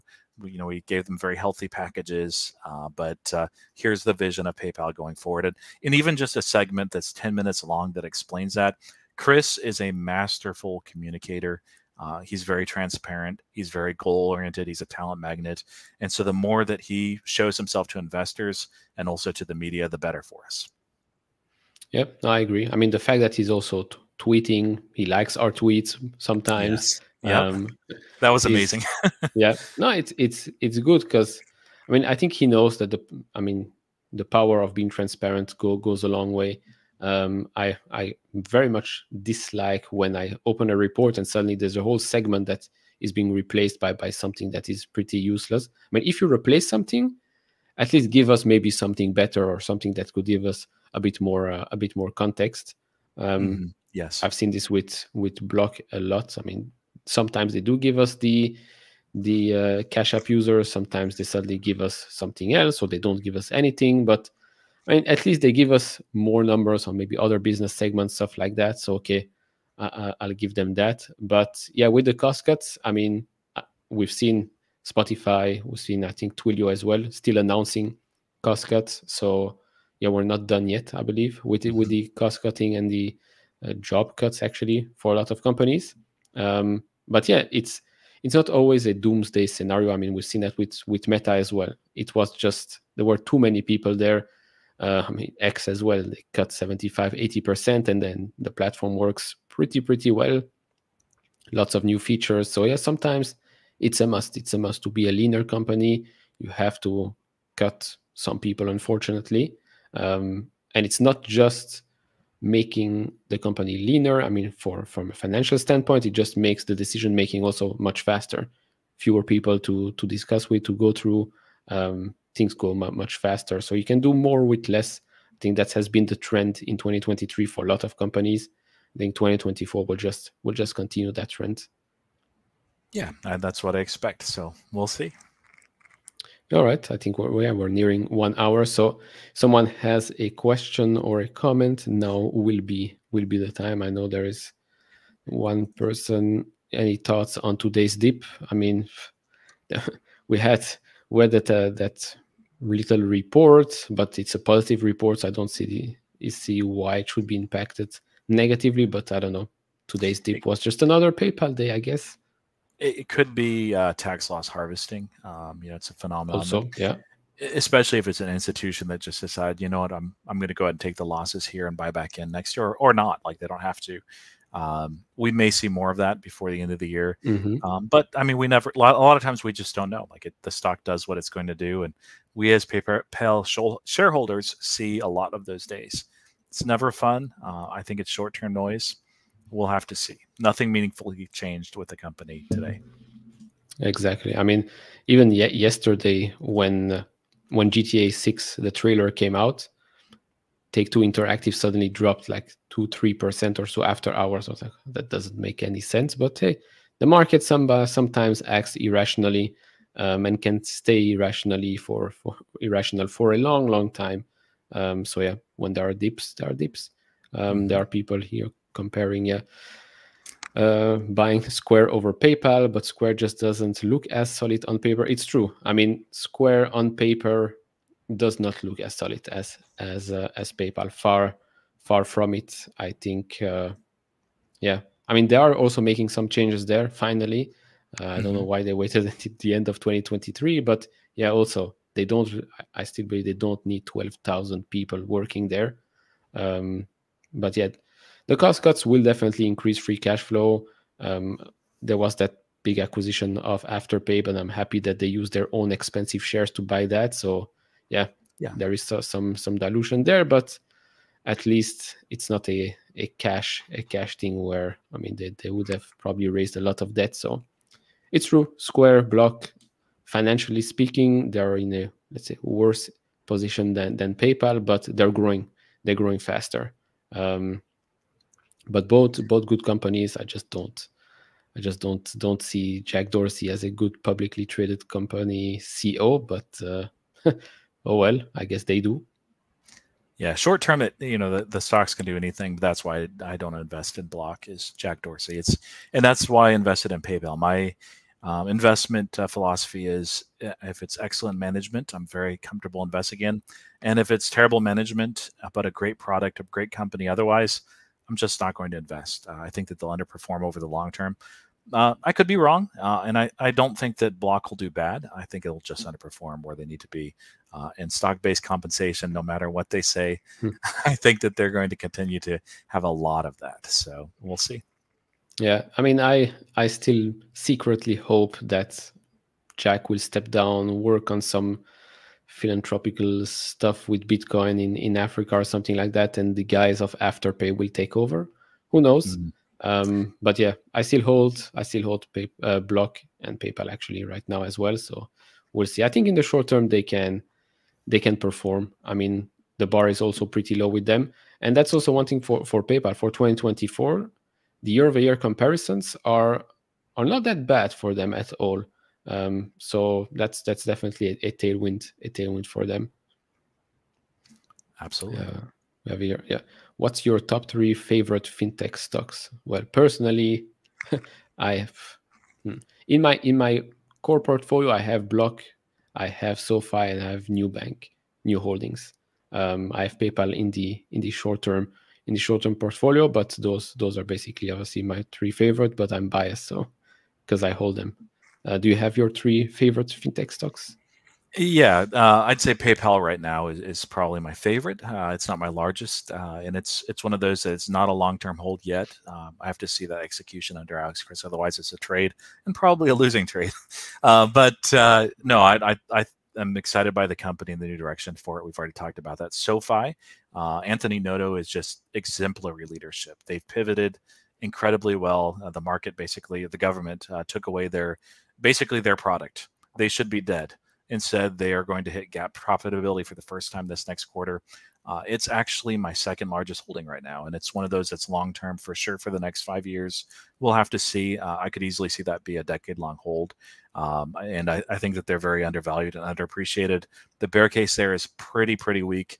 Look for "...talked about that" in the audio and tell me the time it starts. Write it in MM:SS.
06:48.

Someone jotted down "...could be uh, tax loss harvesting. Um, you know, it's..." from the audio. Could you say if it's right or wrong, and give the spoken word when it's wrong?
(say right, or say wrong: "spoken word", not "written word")
right.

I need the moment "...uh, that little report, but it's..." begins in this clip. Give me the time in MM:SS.
02:31.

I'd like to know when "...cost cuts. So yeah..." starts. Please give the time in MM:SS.
01:18.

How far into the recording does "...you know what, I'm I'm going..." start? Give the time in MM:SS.
02:49.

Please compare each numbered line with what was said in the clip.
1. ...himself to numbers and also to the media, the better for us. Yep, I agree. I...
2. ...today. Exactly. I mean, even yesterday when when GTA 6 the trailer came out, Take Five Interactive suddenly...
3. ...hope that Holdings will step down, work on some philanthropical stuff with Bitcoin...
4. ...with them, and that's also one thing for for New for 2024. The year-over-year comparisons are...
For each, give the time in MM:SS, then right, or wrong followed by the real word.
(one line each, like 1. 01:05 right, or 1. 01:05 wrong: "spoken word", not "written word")
1. 00:17 wrong: "investors", not "numbers"
2. 03:12 wrong: "Two", not "Five"
3. 05:27 wrong: "Jack", not "Holdings"
4. 05:50 wrong: "PayPal", not "New".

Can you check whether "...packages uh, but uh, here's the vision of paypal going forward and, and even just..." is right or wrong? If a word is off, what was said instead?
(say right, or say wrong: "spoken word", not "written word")
right.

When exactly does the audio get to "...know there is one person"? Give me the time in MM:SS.
02:23.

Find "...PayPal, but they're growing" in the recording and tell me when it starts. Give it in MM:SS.
04:34.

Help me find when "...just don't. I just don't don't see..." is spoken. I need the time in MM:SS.
04:40.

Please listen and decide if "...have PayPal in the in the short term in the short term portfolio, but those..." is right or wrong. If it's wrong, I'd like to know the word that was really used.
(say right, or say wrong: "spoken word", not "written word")
right.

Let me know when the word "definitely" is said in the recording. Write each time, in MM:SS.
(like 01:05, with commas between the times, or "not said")
04:09, 06:00.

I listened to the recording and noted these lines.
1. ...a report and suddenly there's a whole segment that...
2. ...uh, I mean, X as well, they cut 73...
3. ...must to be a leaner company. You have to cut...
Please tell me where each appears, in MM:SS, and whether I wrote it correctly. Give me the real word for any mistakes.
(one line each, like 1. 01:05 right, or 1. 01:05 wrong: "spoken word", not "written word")
1. 00:40 right
2. 01:34 wrong: "75", not "73"
3. 01:44 right.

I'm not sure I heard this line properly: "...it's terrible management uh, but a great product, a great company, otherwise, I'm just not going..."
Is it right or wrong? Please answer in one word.
right.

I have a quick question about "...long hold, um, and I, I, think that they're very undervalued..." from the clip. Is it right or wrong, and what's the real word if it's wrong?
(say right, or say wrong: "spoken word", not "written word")
right.